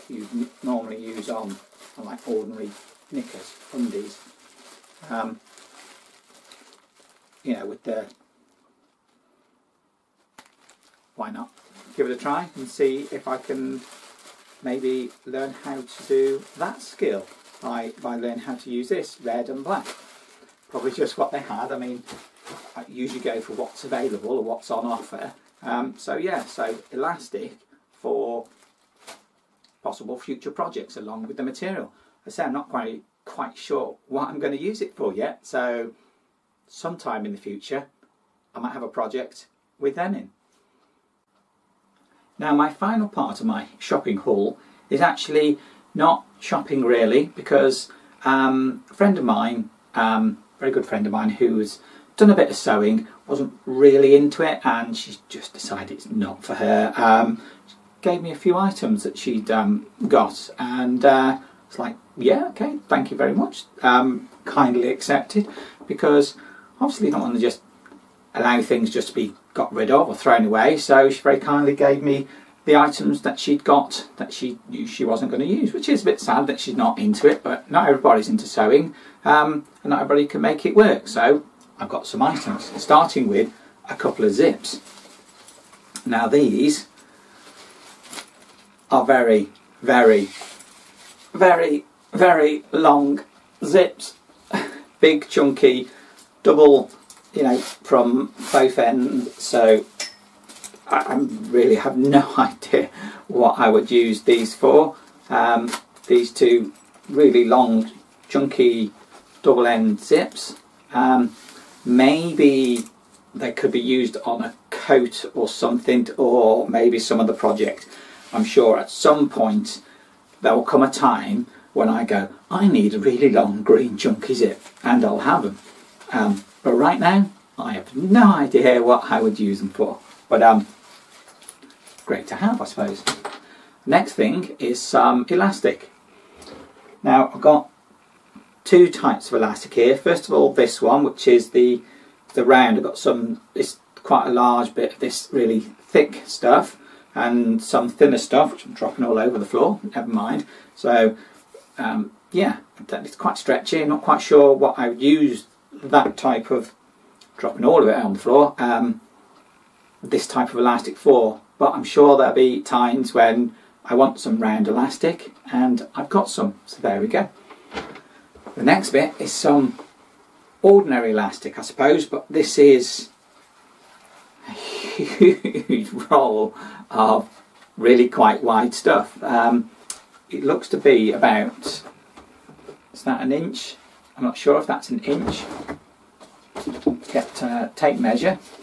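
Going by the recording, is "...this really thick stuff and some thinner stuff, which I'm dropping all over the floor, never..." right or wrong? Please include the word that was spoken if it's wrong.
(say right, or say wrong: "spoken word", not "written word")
right.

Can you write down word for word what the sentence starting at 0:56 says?
Um, gave me a few items that she'd um, got and uh, it's like yeah, okay, thank you very much.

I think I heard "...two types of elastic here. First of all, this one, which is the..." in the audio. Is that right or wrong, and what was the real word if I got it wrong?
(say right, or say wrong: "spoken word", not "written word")
right.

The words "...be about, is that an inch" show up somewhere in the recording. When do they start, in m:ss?
3:00.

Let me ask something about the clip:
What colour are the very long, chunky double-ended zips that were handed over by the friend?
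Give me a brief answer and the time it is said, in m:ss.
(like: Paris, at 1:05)
green, at 2:03.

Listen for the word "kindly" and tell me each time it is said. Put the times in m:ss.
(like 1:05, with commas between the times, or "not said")
1:04, 1:11.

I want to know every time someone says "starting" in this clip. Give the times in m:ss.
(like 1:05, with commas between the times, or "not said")
1:22.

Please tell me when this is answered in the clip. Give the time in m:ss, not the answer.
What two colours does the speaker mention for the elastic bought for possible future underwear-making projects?
0:19.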